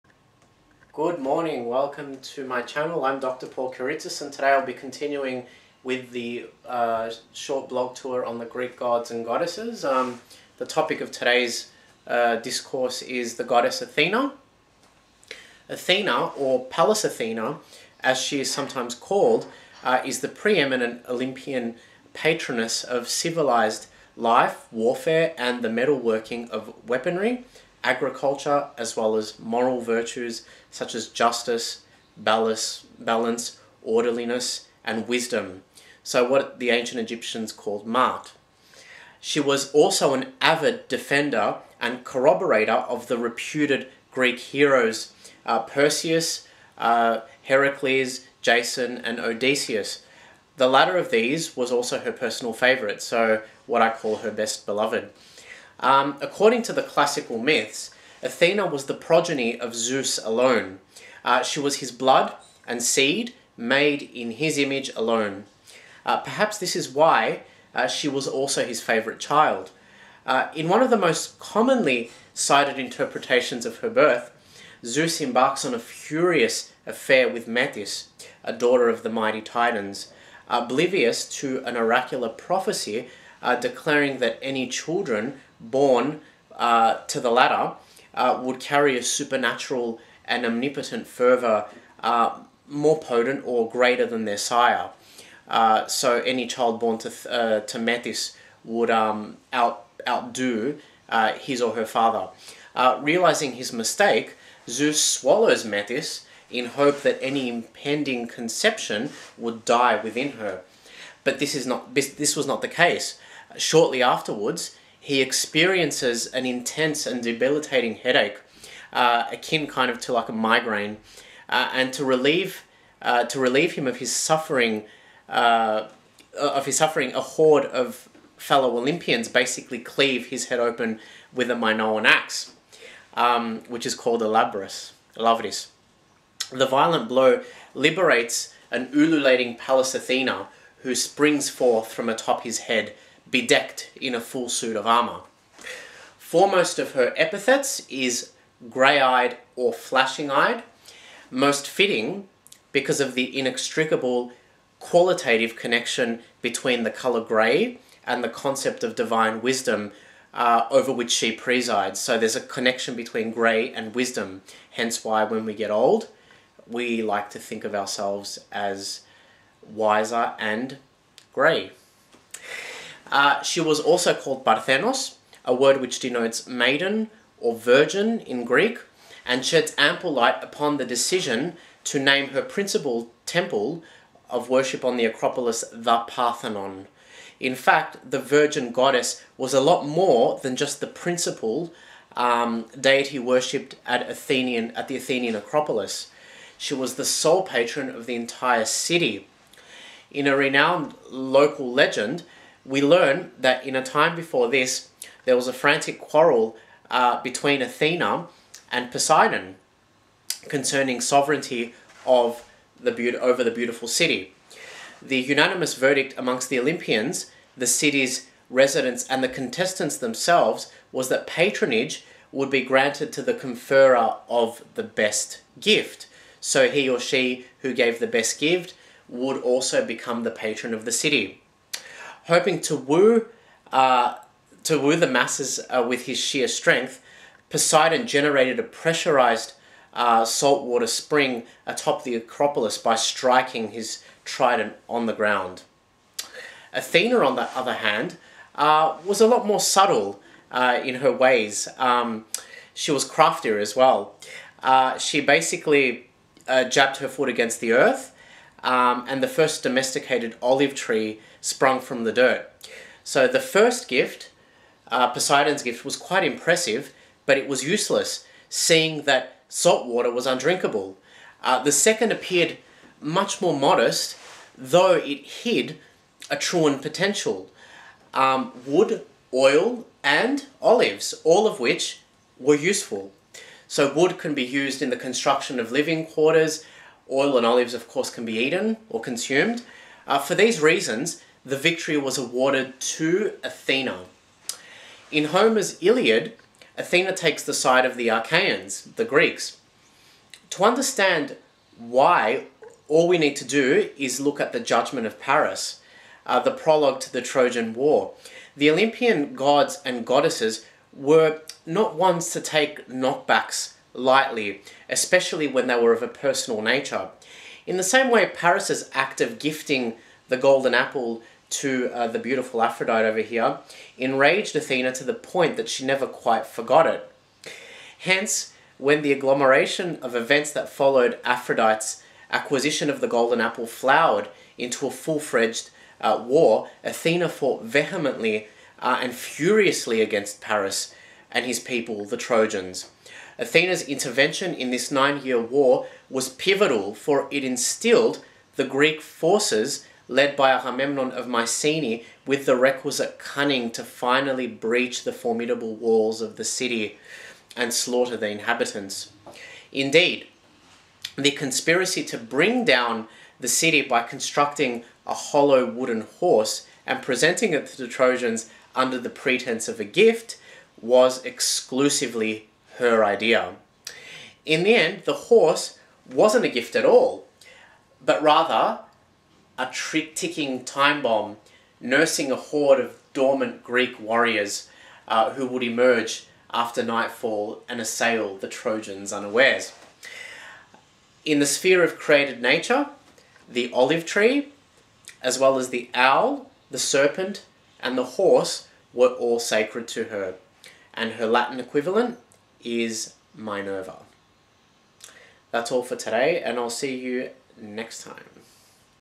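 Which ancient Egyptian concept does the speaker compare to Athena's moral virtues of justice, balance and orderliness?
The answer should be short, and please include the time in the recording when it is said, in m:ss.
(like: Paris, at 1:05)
Maat, at 0:37.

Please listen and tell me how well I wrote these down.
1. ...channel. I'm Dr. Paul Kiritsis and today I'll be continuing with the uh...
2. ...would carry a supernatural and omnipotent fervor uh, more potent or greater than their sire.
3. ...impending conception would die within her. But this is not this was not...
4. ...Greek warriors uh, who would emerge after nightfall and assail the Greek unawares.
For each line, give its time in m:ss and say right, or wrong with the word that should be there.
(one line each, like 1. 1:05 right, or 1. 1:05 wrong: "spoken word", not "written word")
1. 0:02 right
2. 1:28 right
3. 1:47 right
4. 6:23 wrong: "Trojans", not "Greek".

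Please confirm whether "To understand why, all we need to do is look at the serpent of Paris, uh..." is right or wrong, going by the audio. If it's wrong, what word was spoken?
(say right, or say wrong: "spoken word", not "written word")
wrong: "judgment", not "serpent".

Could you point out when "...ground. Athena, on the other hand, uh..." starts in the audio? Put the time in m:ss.
4:05.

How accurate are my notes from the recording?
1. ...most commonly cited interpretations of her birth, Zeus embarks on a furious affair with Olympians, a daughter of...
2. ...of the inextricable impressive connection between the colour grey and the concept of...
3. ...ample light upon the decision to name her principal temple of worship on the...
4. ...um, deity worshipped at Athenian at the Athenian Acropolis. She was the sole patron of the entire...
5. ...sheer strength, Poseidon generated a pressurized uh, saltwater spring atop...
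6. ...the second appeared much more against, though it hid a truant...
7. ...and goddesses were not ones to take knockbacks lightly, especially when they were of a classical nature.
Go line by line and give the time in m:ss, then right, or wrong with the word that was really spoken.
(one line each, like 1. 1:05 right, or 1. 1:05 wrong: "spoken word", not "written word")
1. 1:10 wrong: "Metis", not "Olympians"
2. 2:33 wrong: "qualitative", not "impressive"
3. 2:59 right
4. 3:12 right
5. 3:56 right
6. 4:31 wrong: "modest", not "against"
7. 5:09 wrong: "personal", not "classical".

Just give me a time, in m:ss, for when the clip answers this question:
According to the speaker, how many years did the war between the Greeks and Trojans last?
5:44.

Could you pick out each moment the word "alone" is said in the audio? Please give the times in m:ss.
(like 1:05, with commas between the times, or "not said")
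1:00, 1:04.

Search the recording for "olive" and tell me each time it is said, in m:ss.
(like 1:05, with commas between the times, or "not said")
4:20, 4:40, 4:47, 6:33.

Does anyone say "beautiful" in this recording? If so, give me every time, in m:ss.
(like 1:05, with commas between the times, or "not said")
3:33, 5:22.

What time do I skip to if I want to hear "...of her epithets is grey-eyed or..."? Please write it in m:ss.
2:26.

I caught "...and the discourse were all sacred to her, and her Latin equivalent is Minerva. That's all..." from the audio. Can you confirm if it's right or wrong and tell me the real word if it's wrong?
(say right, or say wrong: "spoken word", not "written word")
wrong: "horse", not "discourse".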